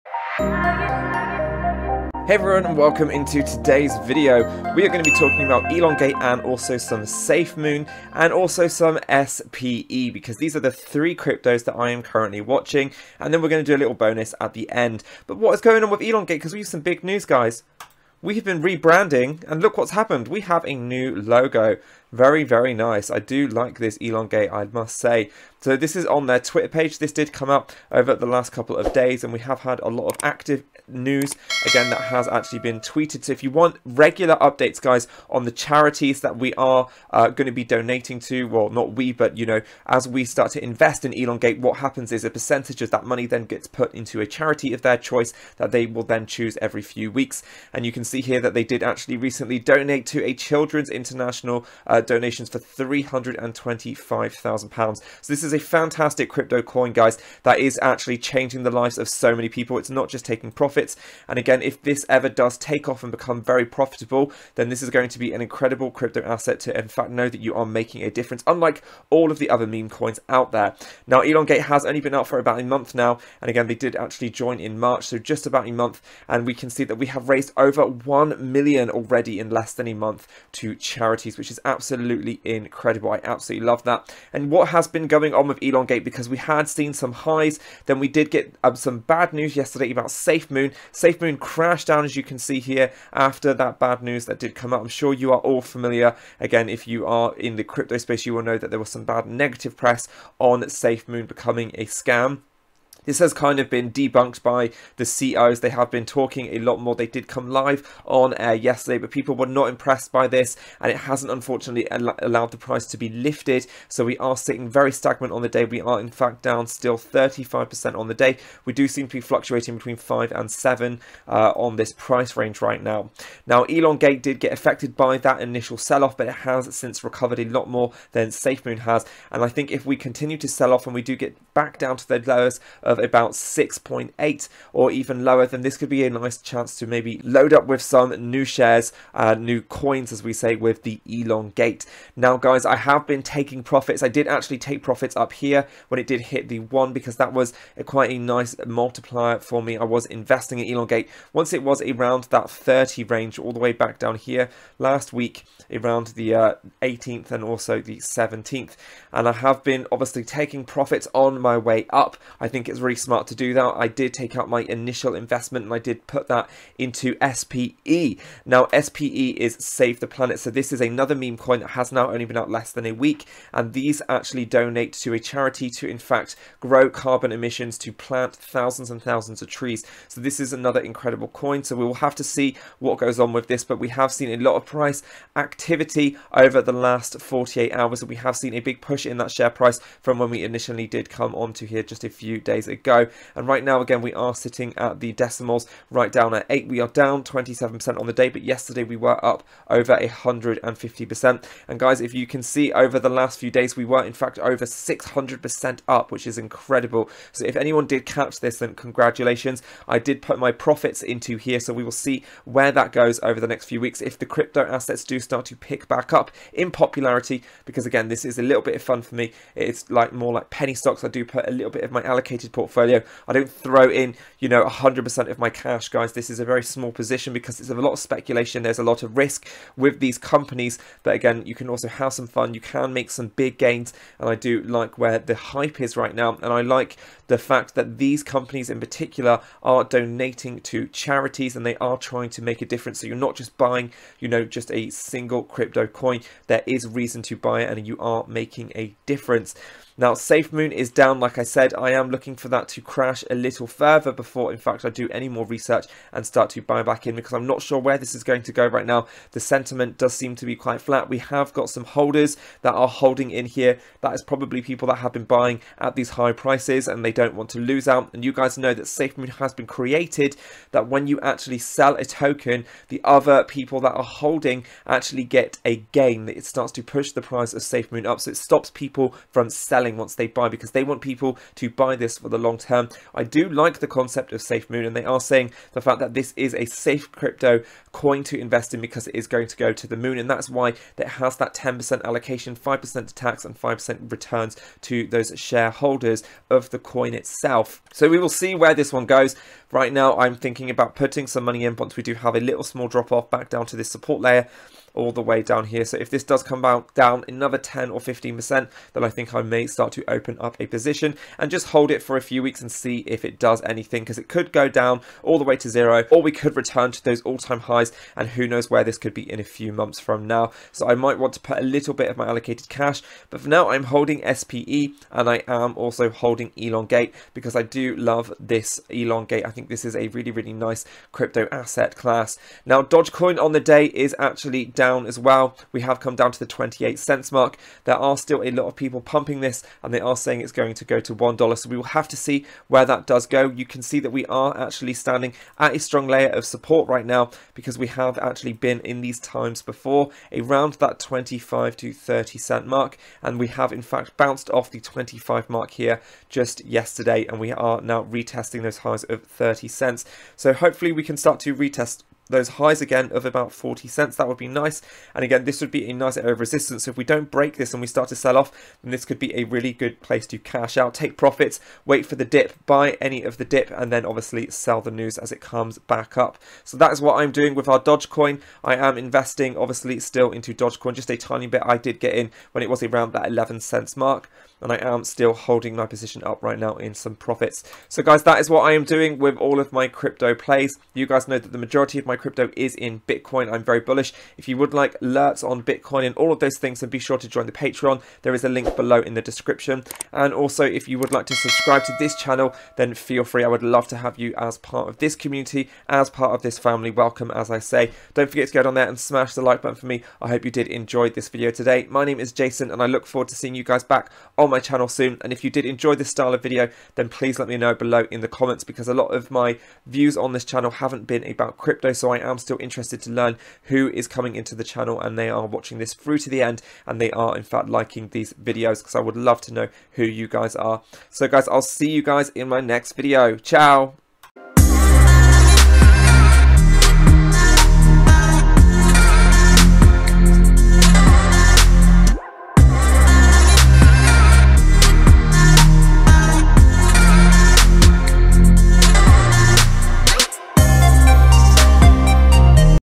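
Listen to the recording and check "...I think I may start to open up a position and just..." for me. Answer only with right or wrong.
right.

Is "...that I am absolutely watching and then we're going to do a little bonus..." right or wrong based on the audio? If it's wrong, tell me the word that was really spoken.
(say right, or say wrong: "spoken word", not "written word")
wrong: "currently", not "absolutely".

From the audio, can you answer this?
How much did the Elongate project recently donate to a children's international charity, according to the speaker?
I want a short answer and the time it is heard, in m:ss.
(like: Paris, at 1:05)
£325,000, at 0:52.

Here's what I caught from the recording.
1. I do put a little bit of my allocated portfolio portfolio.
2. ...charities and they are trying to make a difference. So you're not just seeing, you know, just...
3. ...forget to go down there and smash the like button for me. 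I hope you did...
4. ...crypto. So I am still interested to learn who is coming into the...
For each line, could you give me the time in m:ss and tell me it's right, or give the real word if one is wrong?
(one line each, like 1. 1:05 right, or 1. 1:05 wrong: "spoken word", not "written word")
1. 3:41 right
2. 4:00 wrong: "buying", not "seeing"
3. 6:48 right
4. 7:01 right.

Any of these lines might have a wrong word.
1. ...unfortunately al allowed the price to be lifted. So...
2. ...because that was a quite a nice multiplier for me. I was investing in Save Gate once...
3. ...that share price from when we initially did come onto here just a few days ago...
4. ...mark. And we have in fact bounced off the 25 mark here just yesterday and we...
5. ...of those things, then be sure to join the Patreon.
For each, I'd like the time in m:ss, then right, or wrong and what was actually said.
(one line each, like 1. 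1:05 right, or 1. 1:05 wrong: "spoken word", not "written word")
1. 1:51 right
2. 2:26 wrong: "Elon", not "Save"
3. 3:09 right
4. 5:52 right
5. 6:36 right.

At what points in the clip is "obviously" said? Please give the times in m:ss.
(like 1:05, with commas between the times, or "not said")
2:39, 6:14, 6:19.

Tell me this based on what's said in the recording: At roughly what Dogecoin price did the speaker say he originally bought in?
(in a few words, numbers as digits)
11 cents.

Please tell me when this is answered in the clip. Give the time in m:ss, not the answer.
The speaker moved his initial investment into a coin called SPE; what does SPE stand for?
2:49.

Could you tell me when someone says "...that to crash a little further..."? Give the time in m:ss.
4:12.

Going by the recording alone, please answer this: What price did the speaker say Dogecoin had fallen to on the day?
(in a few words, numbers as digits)
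28 cents.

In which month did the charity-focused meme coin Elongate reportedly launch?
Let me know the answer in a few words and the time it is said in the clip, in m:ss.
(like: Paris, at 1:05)
March, at 1:14.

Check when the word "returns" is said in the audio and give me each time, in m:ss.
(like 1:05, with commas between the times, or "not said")
4:54, 5:16.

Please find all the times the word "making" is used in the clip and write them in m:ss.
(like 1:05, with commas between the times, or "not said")
1:07, 4:08.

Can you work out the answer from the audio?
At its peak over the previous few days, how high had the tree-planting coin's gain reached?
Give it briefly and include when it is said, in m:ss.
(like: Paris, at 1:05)
over 600%, at 3:24.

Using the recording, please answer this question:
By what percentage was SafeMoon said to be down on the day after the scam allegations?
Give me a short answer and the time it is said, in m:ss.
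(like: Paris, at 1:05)
35%, at 1:56.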